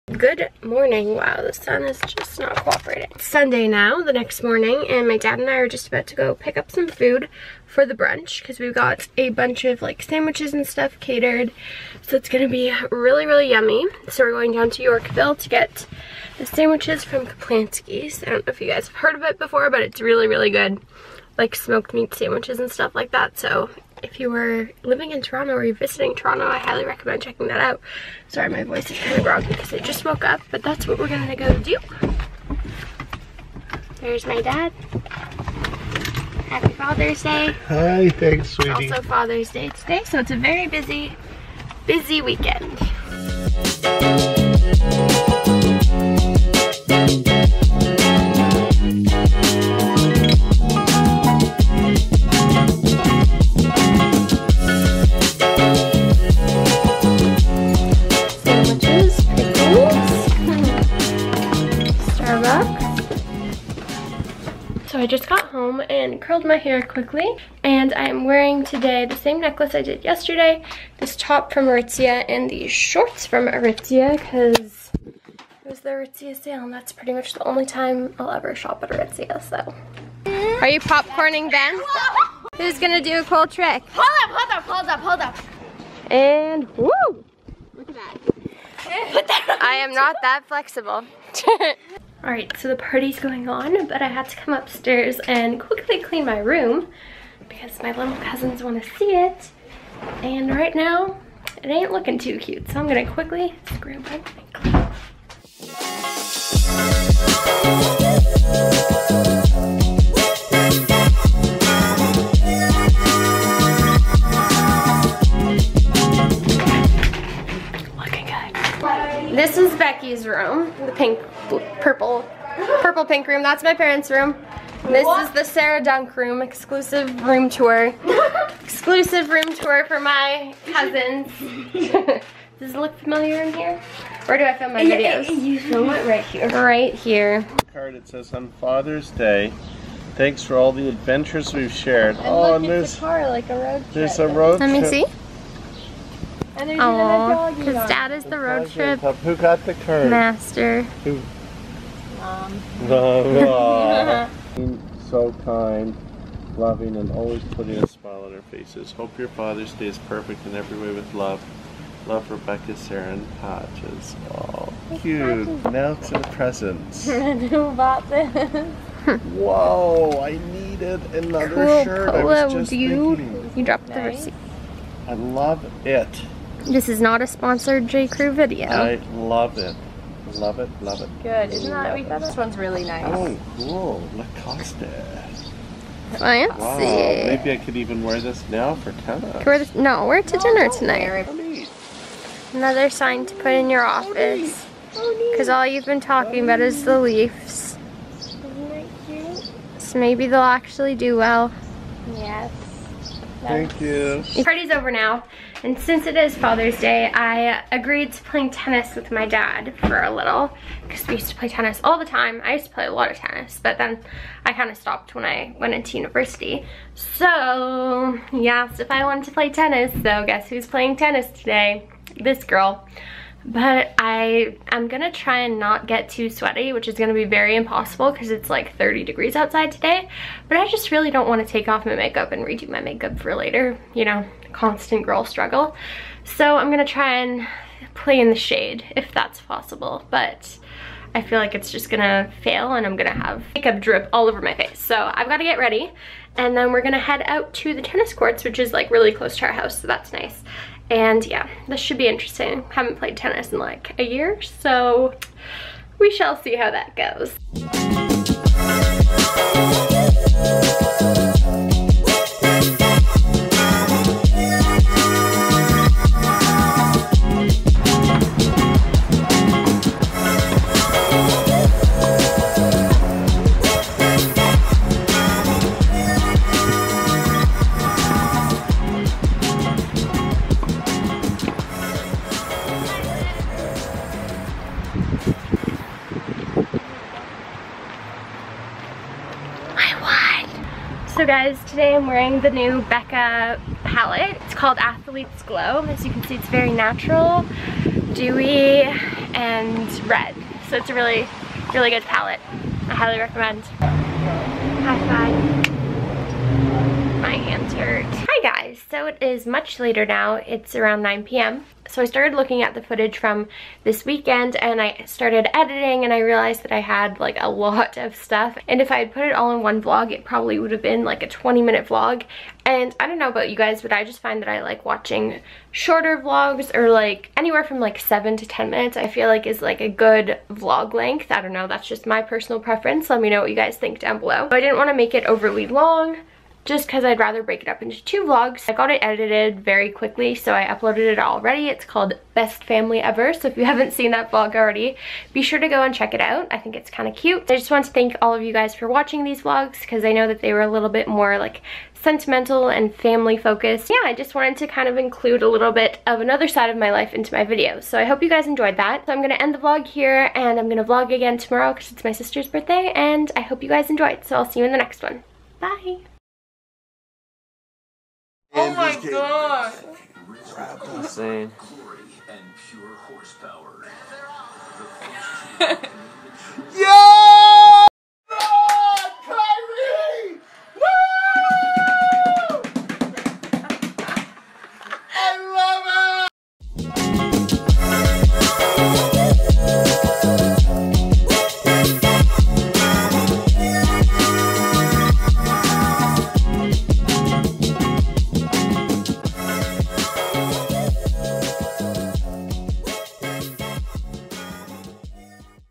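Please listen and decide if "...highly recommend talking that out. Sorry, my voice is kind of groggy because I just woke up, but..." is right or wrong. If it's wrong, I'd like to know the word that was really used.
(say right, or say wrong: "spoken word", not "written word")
wrong: "checking", not "talking".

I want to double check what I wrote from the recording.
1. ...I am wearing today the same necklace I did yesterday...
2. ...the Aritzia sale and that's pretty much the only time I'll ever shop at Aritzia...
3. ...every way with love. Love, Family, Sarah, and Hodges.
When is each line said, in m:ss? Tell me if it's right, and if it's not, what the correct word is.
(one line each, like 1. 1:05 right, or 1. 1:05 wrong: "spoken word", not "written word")
1. 1:07 right
2. 1:15 right
3. 2:40 wrong: "Rebecca", not "Family".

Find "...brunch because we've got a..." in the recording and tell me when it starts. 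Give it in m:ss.
0:07.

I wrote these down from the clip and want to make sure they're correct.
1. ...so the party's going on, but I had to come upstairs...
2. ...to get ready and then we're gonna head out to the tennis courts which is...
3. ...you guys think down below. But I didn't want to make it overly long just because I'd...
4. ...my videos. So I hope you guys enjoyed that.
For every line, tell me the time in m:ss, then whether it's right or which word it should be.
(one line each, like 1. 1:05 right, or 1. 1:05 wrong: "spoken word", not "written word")
1. 1:32 right
2. 4:05 right
3. 5:33 right
4. 5:57 right.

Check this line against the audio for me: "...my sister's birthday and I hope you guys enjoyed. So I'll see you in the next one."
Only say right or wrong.
right.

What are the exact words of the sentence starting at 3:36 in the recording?
So, he asked if I wanted to play tennis, so guess who's playing tennis today?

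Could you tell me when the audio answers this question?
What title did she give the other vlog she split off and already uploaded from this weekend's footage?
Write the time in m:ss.
5:42.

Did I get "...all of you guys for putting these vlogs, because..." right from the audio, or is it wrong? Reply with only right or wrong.
wrong.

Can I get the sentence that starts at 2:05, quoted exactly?
is the Sarah Dunk room, exclusive room tour.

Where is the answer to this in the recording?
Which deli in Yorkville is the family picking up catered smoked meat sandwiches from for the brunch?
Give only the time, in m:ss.
0:17.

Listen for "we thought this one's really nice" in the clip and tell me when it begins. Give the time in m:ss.
3:01.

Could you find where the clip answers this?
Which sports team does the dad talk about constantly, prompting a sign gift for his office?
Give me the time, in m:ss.
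3:16.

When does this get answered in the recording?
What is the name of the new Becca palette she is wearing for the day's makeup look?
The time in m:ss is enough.
4:54.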